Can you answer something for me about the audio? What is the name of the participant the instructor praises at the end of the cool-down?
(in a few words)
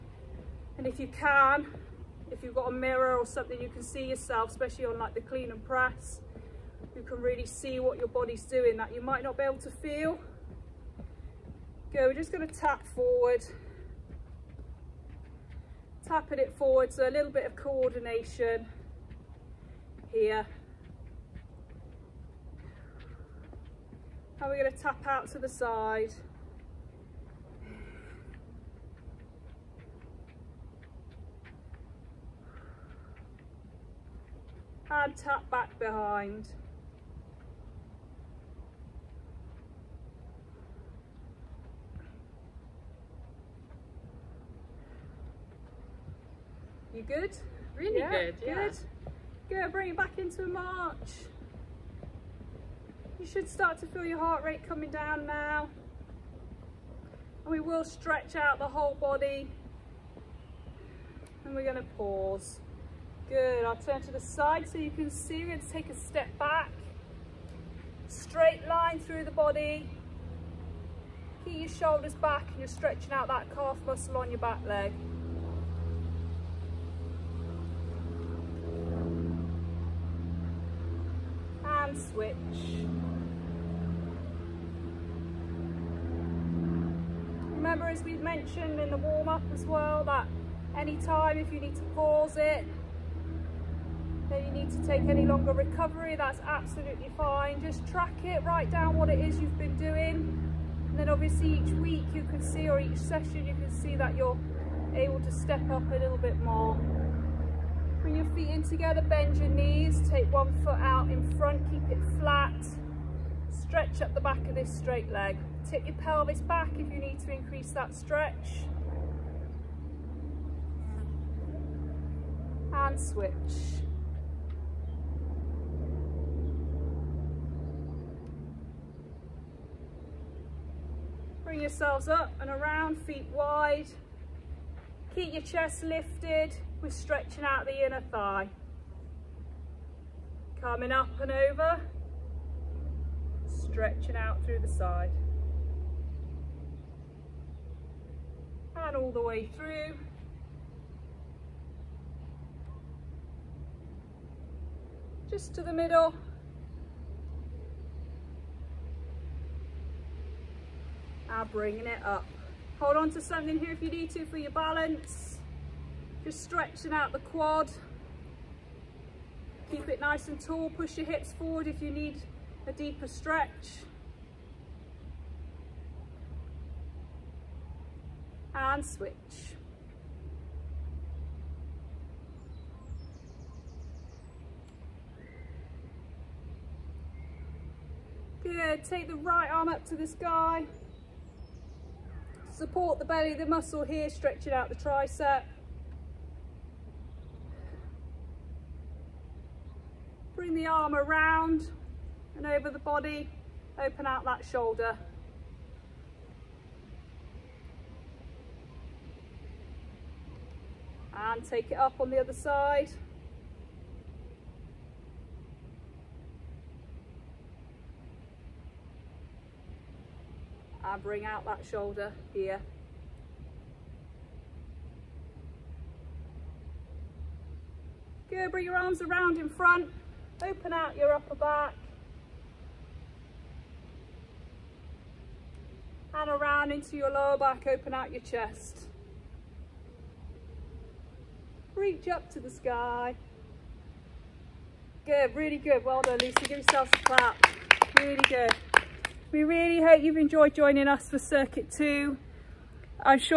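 Lucy.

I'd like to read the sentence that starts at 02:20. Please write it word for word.
Coming up and over, stretching out through the side.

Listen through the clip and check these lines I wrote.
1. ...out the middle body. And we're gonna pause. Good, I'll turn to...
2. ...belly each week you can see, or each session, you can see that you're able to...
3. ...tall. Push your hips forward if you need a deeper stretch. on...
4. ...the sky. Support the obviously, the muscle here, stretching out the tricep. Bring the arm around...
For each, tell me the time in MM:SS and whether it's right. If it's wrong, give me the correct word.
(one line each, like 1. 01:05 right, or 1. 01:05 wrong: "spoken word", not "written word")
1. 00:58 wrong: "whole", not "middle"
2. 01:41 wrong: "obviously", not "belly"
3. 02:50 right
4. 03:09 wrong: "belly", not "obviously".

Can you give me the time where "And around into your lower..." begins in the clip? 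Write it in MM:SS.
03:56.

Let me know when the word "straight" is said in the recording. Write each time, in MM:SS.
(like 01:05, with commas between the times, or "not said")
01:08, 01:54.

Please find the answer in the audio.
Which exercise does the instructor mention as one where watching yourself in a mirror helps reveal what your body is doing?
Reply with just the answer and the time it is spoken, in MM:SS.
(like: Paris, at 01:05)
Clean and press, at 00:05.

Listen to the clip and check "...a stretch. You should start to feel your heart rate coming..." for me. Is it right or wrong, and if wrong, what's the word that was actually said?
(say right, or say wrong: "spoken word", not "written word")
wrong: "march", not "stretch".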